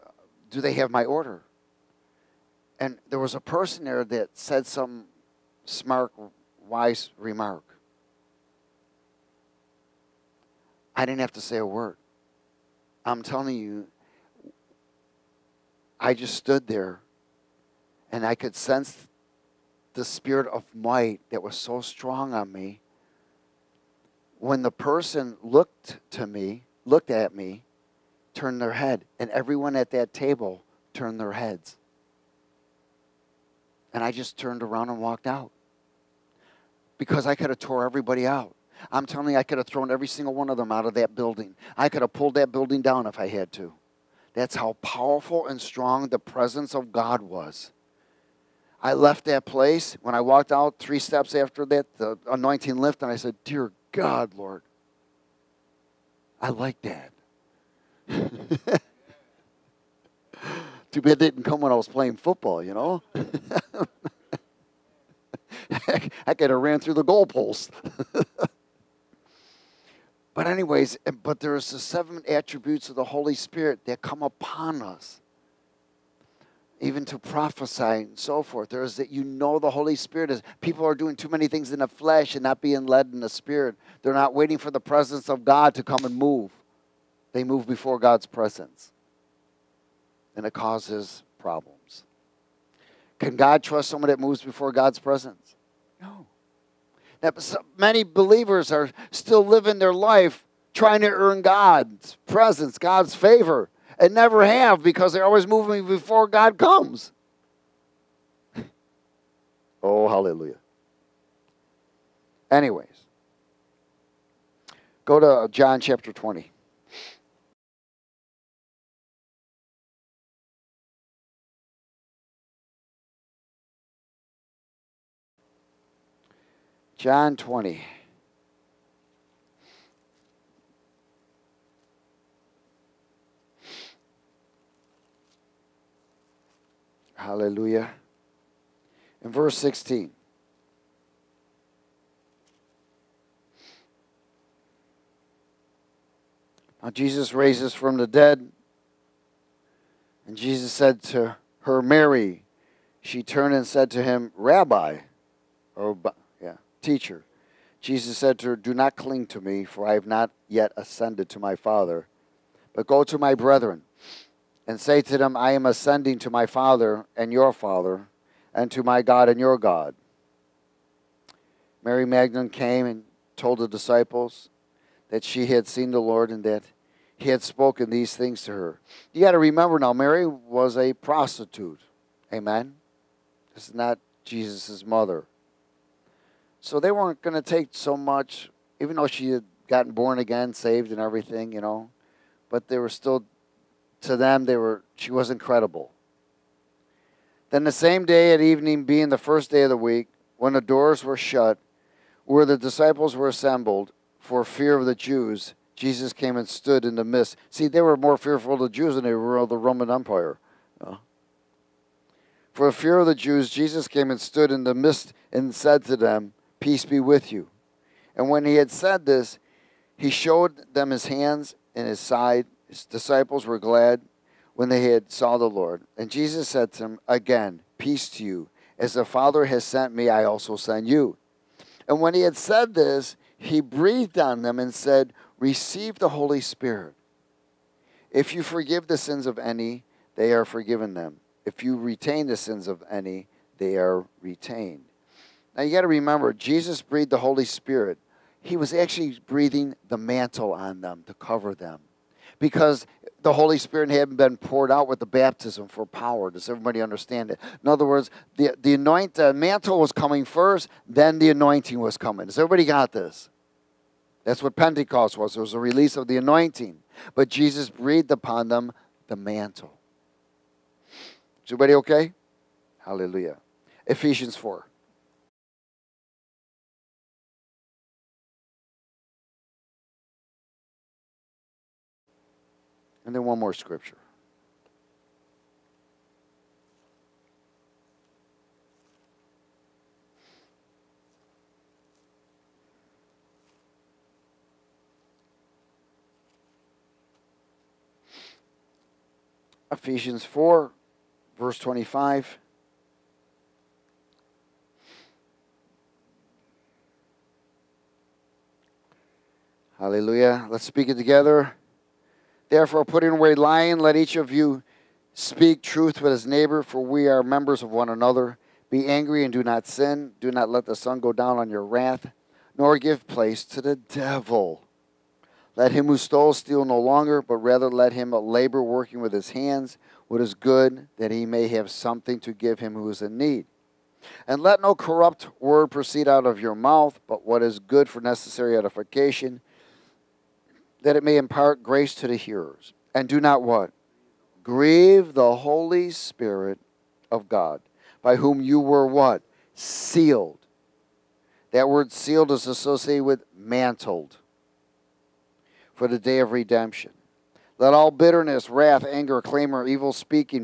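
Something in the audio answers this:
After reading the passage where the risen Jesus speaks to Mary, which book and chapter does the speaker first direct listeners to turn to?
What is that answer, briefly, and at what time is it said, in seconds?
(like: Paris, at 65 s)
John 20, at 115 s.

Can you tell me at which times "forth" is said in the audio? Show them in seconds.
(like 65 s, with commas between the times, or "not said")
78 s.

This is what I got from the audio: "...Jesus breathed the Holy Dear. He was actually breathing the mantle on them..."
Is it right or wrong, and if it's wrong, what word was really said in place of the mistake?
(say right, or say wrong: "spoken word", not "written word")
wrong: "Spirit", not "Dear".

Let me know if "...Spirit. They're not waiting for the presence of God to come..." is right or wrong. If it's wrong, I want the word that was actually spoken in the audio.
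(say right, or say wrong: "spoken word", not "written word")
right.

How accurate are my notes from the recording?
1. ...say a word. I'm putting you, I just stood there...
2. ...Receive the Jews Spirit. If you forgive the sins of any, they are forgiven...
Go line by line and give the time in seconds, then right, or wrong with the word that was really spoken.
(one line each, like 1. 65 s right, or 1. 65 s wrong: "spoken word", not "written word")
1. 11 s wrong: "telling", not "putting"
2. 235 s wrong: "Holy", not "Jews".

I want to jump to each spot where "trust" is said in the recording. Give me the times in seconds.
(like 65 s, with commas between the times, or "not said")
93 s.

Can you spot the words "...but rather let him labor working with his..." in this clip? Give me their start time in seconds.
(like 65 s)
327 s.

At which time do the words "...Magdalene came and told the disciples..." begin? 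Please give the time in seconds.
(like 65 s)
172 s.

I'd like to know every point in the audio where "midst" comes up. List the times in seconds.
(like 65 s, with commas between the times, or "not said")
207 s, 214 s.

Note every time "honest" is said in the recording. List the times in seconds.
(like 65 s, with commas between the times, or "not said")
not said.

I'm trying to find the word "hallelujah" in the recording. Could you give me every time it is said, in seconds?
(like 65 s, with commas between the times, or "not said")
110 s, 137 s, 272 s, 309 s.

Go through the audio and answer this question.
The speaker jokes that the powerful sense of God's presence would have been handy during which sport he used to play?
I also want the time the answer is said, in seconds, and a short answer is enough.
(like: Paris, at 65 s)
Football, at 62 s.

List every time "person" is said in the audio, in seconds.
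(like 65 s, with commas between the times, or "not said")
3 s, 24 s.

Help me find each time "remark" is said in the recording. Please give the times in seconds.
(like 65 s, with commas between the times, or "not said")
7 s.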